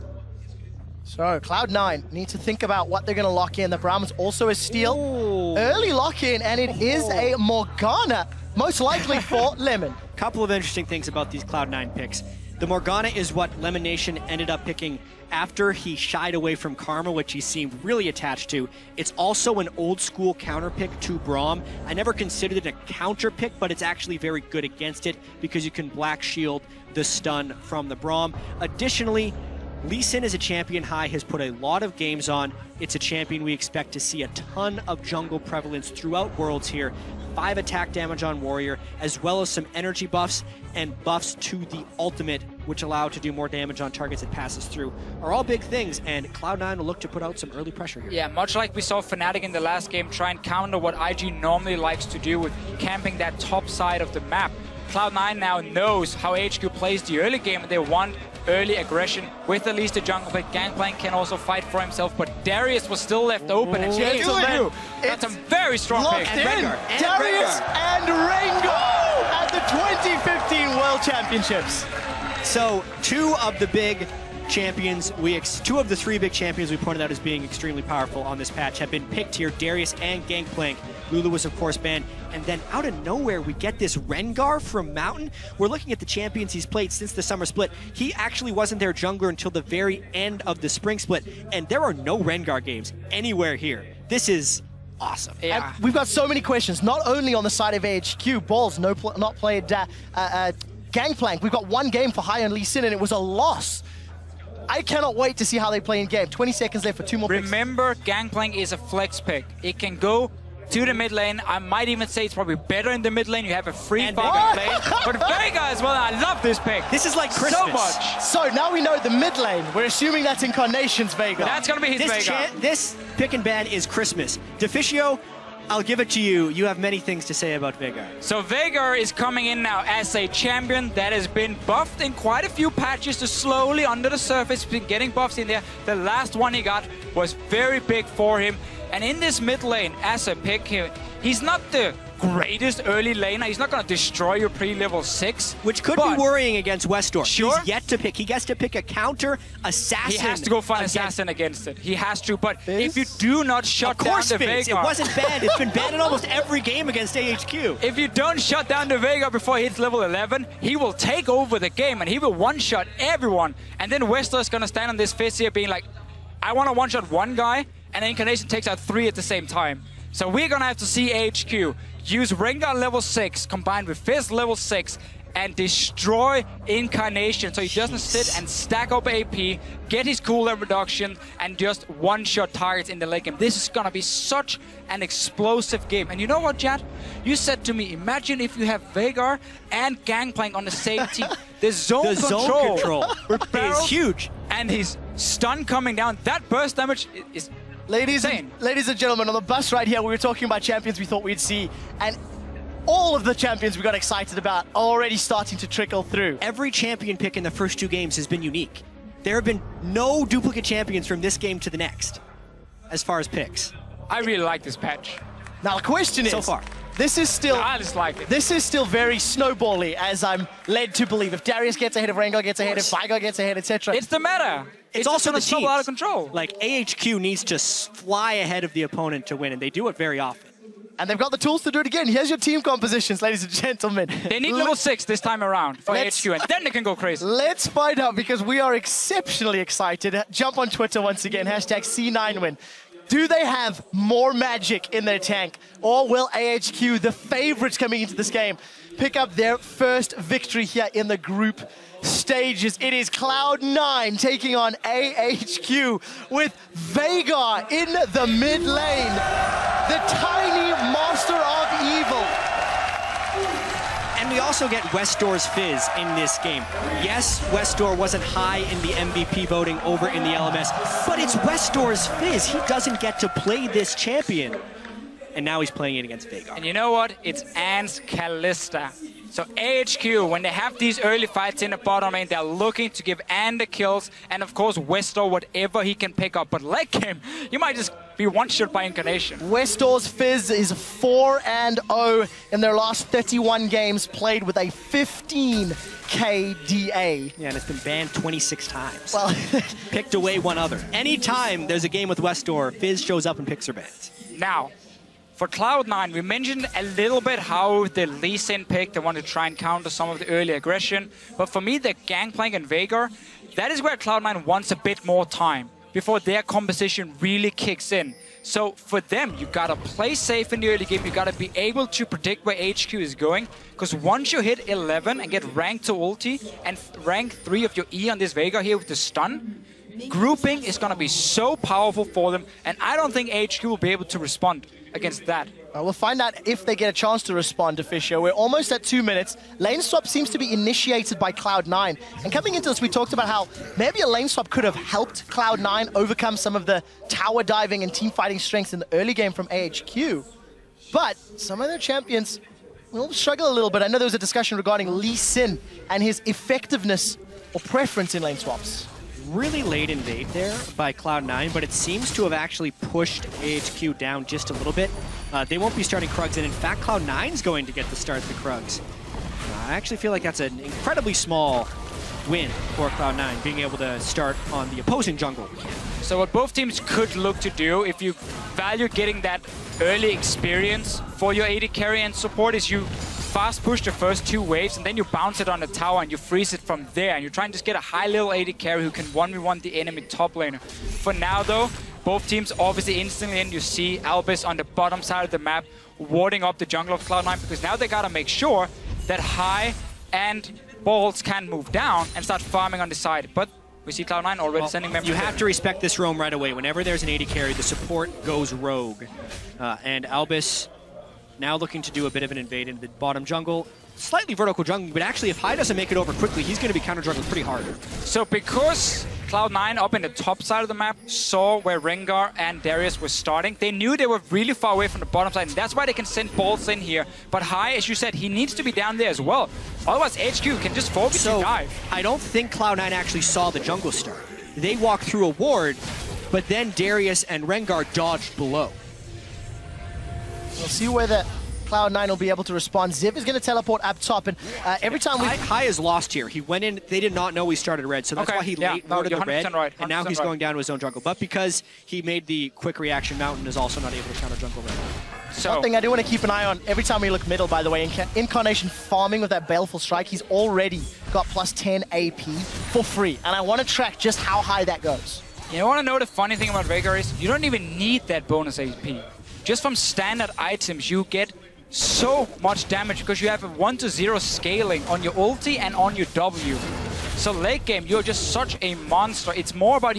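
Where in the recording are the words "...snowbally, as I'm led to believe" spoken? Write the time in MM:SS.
03:39.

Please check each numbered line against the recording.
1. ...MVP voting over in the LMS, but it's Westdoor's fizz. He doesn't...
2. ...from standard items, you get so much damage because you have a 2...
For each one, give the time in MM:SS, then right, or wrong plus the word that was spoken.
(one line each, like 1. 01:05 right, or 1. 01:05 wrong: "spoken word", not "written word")
1. 04:28 right
2. 07:49 wrong: "1", not "2".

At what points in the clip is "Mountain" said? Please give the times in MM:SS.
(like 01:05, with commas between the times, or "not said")
01:24, 07:33.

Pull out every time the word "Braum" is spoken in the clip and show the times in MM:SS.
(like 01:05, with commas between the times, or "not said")
00:21, 00:27.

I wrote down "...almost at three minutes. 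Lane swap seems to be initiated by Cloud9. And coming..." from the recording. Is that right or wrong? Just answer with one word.
wrong.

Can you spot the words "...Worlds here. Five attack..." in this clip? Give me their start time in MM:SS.
00:36.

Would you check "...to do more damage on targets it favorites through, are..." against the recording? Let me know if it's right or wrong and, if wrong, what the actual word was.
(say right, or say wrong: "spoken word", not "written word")
wrong: "passes", not "favorites".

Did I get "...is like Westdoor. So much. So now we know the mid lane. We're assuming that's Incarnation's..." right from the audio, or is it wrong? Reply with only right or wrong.
wrong.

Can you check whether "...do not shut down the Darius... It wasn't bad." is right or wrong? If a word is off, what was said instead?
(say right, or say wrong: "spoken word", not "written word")
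wrong: "Veigar", not "Darius".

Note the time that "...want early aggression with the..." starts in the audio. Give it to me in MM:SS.
00:57.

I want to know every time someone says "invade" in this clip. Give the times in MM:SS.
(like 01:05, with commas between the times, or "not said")
05:59, 06:52.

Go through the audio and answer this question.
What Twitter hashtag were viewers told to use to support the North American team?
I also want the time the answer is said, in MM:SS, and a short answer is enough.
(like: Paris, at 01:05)
C9Win, at 04:01.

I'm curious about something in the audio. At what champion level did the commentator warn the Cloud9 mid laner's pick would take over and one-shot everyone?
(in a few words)
11.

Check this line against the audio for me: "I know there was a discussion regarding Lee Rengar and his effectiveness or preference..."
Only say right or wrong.
wrong.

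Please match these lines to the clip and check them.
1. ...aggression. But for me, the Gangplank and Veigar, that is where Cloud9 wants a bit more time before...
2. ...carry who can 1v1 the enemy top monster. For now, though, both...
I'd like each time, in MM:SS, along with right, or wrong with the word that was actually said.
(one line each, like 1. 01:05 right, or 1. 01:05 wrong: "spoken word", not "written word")
1. 05:10 right
2. 06:28 wrong: "laner", not "monster".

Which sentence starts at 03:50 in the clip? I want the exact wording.
And they've got the tools to do it again.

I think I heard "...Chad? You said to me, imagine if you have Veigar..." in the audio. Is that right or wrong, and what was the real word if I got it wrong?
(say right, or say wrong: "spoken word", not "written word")
right.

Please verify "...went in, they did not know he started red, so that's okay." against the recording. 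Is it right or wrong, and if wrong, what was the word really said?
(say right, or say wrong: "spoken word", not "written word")
right.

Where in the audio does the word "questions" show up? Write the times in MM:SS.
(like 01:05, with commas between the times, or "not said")
01:36, 03:35.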